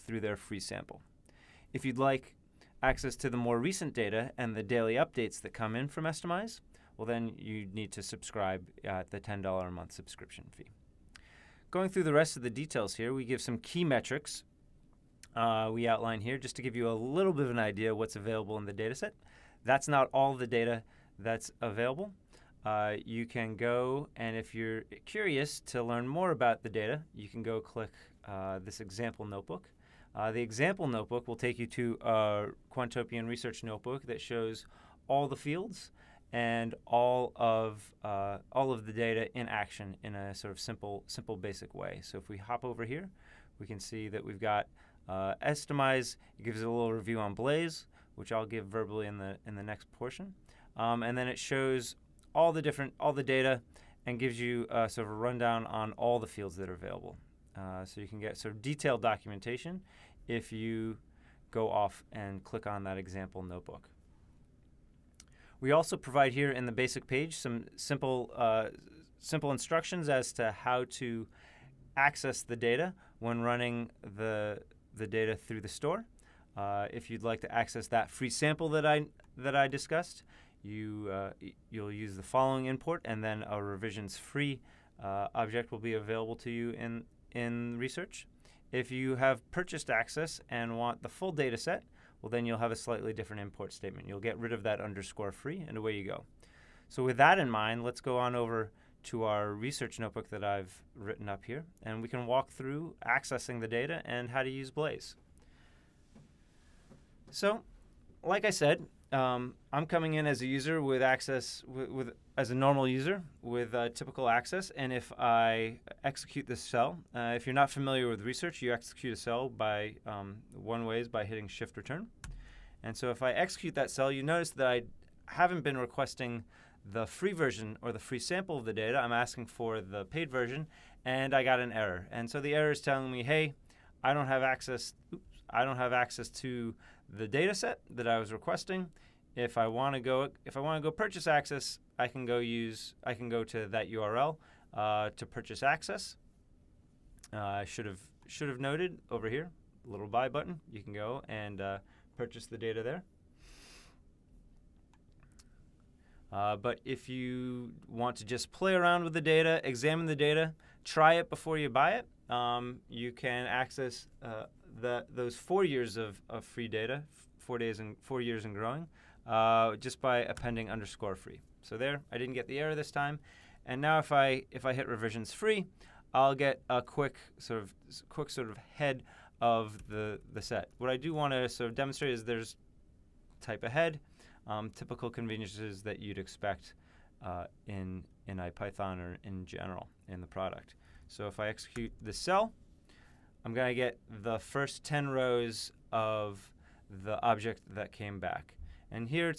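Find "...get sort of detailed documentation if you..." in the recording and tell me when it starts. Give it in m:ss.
0:58.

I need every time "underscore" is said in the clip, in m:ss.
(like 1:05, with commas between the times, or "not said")
1:34, 2:50.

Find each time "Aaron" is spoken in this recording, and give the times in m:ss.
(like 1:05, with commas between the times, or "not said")
not said.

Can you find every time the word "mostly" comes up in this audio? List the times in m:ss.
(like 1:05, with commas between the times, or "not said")
not said.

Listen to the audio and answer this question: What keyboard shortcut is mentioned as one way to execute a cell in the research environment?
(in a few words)
shift return.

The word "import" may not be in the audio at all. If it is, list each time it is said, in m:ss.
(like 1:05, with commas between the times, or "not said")
1:22, 1:33.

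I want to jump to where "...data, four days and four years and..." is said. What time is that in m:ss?
2:46.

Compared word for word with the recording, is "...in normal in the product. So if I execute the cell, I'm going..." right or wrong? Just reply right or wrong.
wrong.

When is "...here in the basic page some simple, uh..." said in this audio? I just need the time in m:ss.
1:06.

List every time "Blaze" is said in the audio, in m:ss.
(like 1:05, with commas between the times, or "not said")
0:47, 1:44.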